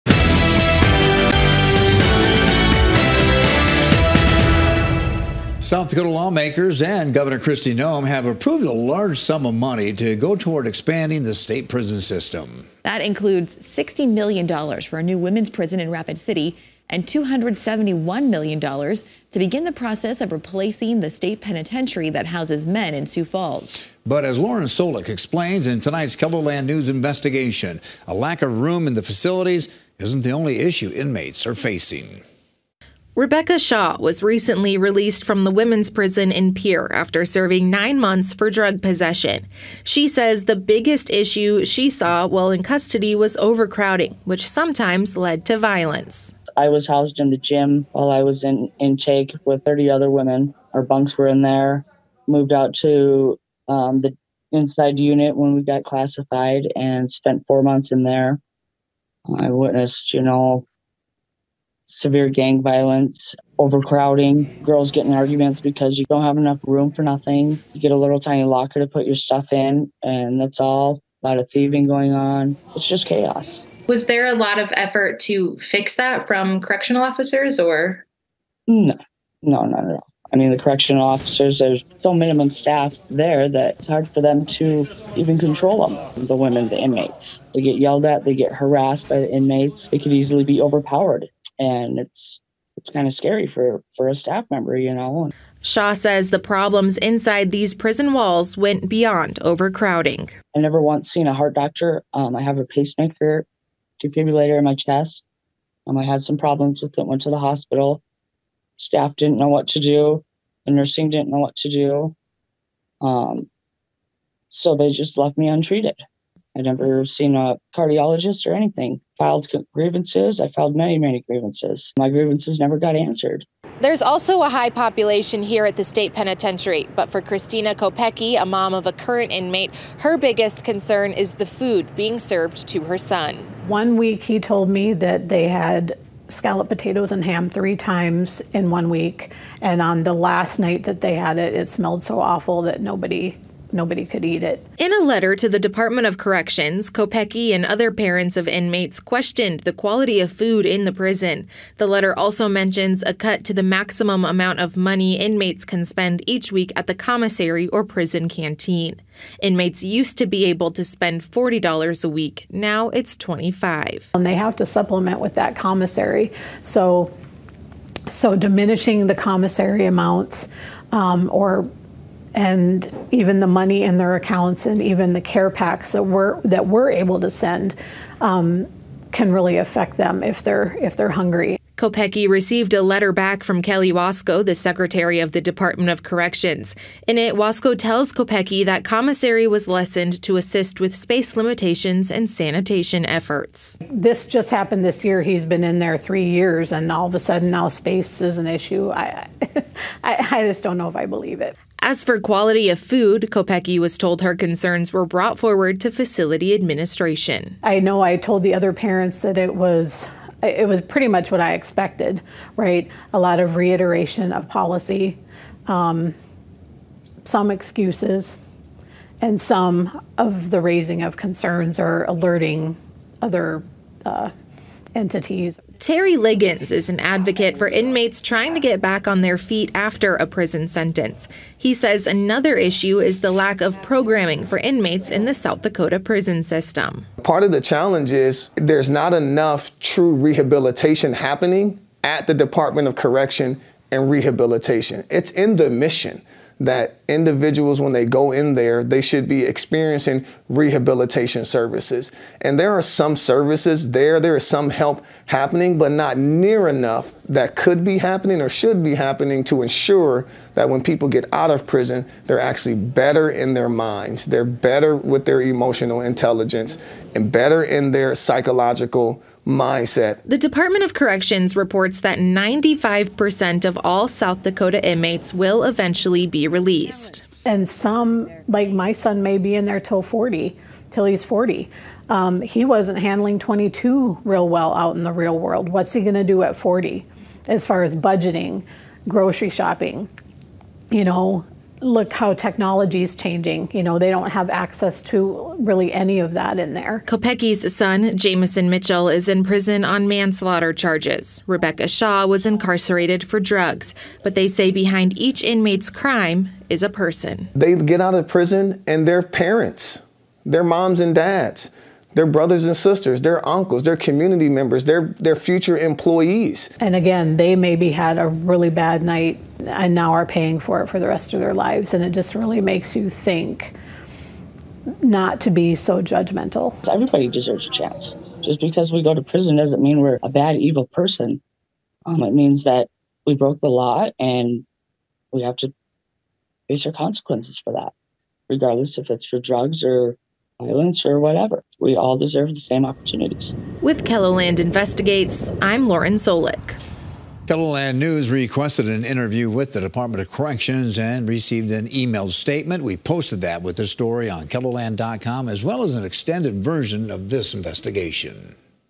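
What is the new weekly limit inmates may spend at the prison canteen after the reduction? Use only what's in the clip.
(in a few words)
$25.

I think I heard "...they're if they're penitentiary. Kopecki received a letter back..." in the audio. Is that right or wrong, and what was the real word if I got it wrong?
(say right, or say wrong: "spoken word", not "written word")
wrong: "hungry", not "penitentiary".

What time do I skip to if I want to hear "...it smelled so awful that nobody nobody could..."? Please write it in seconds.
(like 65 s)
141 s.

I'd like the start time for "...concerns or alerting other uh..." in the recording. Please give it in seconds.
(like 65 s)
221 s.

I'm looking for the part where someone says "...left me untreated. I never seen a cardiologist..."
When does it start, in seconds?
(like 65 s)
115 s.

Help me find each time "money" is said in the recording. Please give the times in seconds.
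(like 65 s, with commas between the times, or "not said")
9 s, 154 s, 173 s.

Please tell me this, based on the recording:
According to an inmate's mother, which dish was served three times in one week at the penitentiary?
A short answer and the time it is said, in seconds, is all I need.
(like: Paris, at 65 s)
scalloped potatoes and ham, at 136 s.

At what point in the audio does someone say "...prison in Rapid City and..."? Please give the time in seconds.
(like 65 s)
15 s.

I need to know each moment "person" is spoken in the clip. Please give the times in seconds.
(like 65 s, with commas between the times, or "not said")
306 s, 330 s.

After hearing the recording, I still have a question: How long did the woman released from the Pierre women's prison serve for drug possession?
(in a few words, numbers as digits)
nine months.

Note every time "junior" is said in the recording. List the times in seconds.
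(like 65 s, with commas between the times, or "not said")
not said.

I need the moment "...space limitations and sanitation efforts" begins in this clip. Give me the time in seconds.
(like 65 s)
190 s.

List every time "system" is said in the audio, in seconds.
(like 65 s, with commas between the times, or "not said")
12 s, 236 s.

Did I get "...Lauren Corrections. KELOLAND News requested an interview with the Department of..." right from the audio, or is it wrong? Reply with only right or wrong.
wrong.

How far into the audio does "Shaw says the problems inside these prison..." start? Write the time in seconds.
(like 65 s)
95 s.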